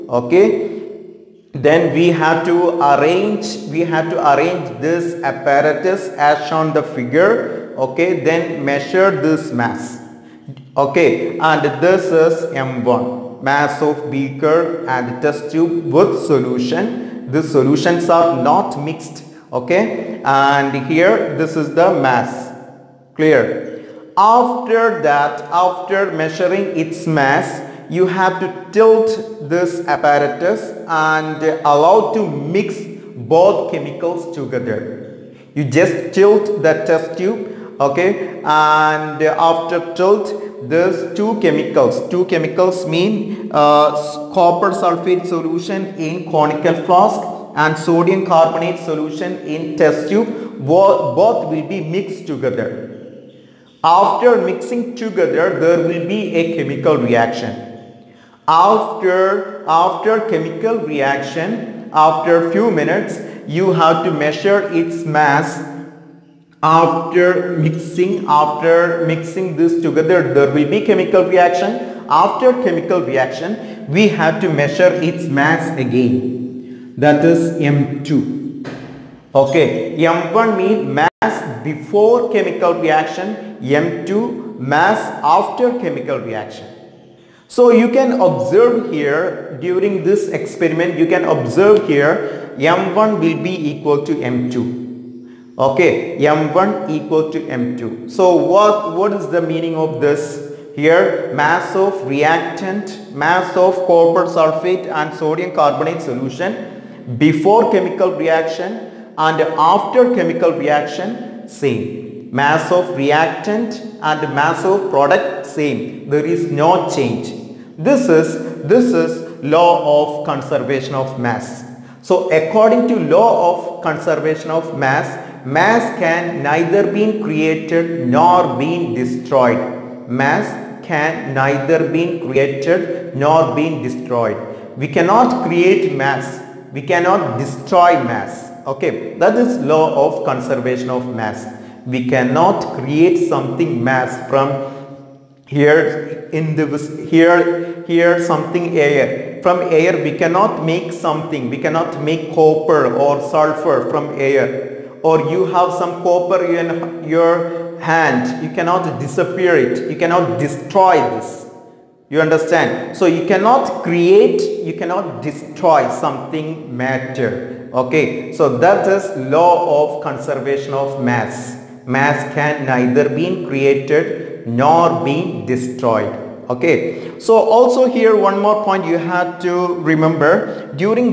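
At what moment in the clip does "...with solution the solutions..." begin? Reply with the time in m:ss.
0:15.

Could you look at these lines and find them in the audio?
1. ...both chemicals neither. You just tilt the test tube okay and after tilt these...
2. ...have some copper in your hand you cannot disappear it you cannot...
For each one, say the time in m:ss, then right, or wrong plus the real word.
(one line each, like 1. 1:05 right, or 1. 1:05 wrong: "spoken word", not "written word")
1. 0:33 wrong: "together", not "neither"
2. 2:35 right.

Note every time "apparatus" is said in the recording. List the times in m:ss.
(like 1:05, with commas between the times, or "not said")
0:05, 0:29.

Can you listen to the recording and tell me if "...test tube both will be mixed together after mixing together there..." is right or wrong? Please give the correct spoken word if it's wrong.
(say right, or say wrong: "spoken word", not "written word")
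right.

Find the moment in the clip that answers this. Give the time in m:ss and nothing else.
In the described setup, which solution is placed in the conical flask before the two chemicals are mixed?
0:44.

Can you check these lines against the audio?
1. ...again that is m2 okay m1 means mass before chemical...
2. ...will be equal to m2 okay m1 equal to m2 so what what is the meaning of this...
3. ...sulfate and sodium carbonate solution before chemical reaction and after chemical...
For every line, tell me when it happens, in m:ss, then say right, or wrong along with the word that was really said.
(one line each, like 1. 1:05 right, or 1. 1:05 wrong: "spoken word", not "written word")
1. 1:15 right
2. 1:33 right
3. 1:44 right.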